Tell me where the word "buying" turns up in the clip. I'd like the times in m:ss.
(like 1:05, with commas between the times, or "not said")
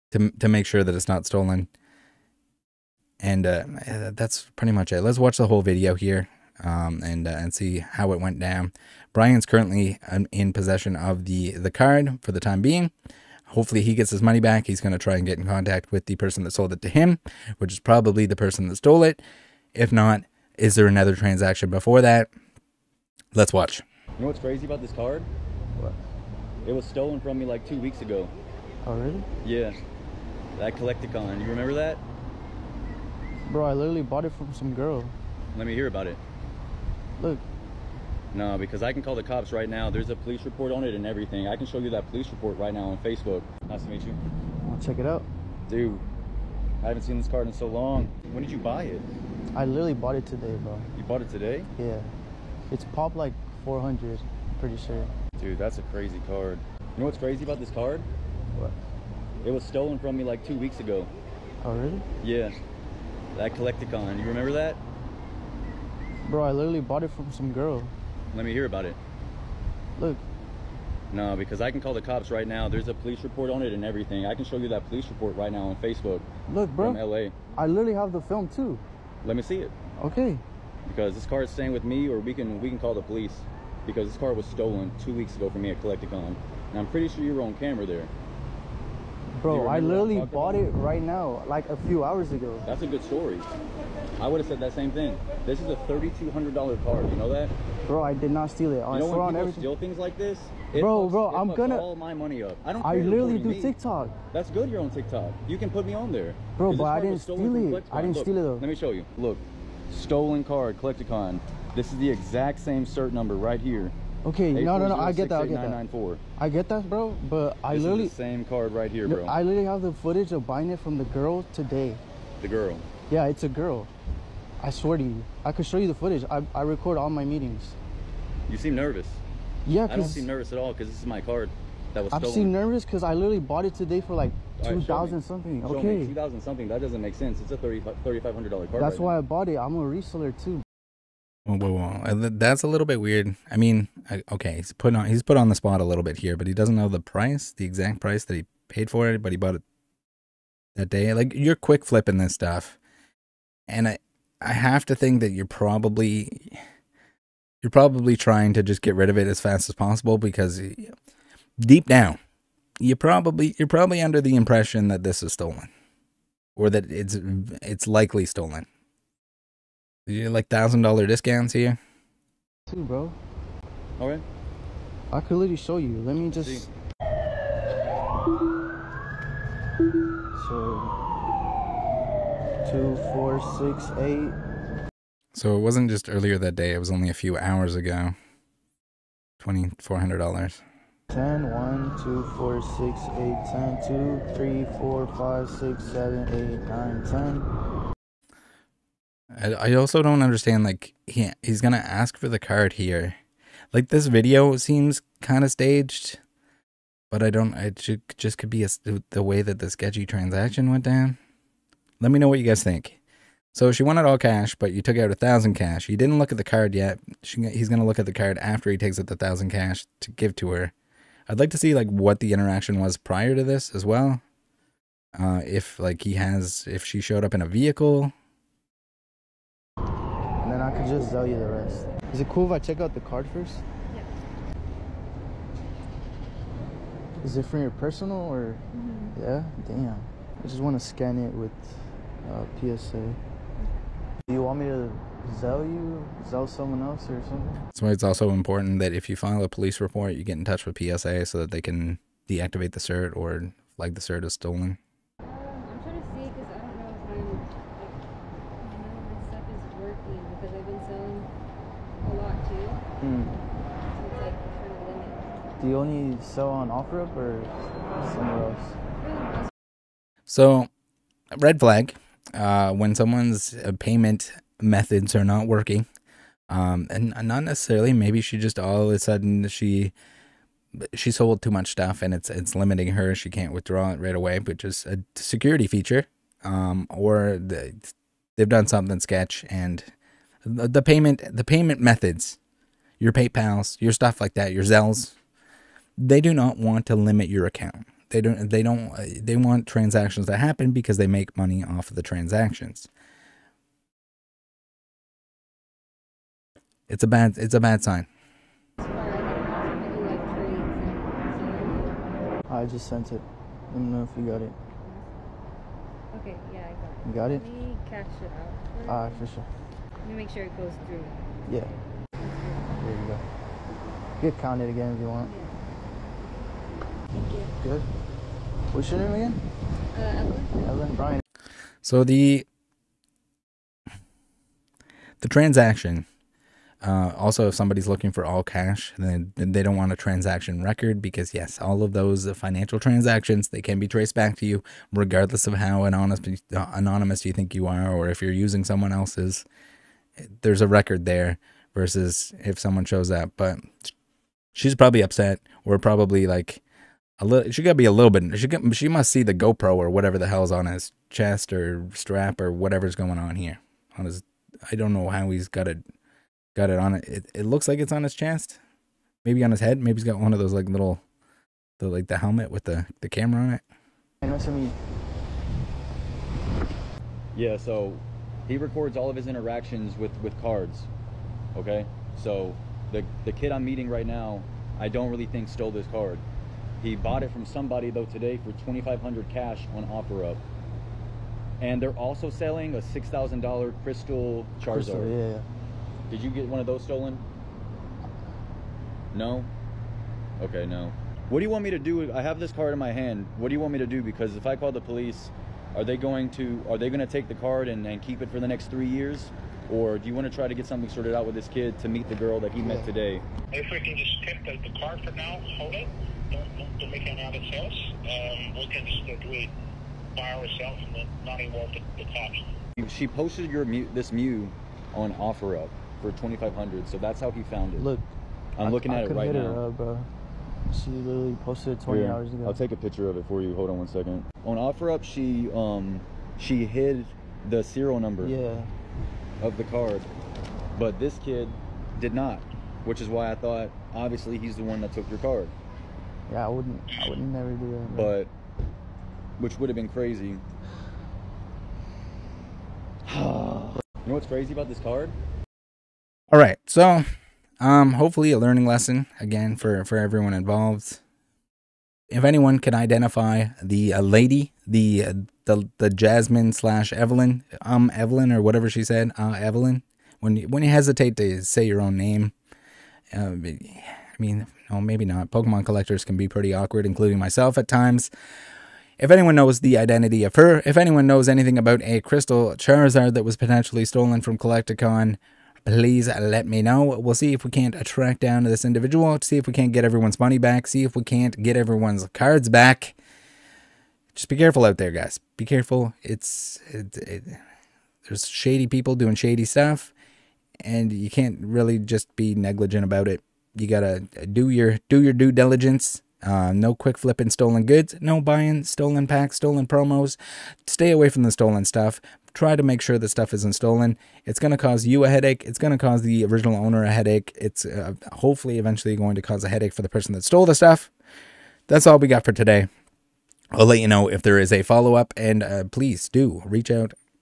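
2:00, 8:28.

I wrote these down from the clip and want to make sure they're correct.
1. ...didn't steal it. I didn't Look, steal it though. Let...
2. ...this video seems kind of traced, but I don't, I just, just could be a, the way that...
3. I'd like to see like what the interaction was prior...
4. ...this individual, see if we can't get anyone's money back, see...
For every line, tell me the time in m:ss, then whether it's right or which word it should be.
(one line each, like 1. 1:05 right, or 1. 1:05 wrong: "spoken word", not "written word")
1. 1:47 right
2. 3:23 wrong: "staged", not "traced"
3. 3:41 right
4. 8:08 wrong: "everyone", not "anyone".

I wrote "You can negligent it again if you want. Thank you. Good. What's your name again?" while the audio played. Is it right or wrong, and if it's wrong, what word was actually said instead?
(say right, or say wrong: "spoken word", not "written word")
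wrong: "count", not "negligent".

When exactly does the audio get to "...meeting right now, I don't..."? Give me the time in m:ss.
6:23.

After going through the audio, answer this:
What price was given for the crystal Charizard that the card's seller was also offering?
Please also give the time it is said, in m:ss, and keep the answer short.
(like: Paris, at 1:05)
$6,000, at 6:32.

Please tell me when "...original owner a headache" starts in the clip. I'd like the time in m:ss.
8:36.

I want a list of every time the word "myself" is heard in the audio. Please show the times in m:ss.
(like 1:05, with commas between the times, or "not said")
7:57.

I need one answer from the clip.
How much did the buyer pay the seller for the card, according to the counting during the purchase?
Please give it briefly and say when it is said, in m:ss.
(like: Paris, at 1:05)
$2,400, at 3:09.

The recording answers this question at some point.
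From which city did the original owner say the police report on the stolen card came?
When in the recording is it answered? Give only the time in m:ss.
1:16.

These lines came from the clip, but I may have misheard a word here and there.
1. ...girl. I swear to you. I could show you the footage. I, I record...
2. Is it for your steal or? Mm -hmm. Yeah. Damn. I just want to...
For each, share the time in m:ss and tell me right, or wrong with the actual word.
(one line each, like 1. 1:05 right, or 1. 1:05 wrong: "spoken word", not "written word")
1. 2:03 right
2. 3:57 wrong: "personal", not "steal".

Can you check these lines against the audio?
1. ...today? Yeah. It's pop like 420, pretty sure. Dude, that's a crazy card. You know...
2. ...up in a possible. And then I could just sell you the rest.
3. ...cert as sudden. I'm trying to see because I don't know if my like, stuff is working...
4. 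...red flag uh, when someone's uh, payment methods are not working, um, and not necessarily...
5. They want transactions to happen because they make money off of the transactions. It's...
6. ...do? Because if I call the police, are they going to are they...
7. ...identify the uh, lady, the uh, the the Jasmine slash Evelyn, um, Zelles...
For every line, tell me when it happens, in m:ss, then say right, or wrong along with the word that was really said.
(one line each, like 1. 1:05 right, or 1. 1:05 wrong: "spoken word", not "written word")
1. 0:51 wrong: "400", not "420"
2. 3:47 wrong: "vehicle", not "possible"
3. 4:14 wrong: "stolen", not "sudden"
4. 4:31 right
5. 4:59 right
6. 6:43 right
7. 7:42 wrong: "Evelyn", not "Zelles".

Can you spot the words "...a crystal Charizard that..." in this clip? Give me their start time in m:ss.
8:01.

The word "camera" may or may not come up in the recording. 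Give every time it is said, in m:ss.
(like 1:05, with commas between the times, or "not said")
1:27, 6:13.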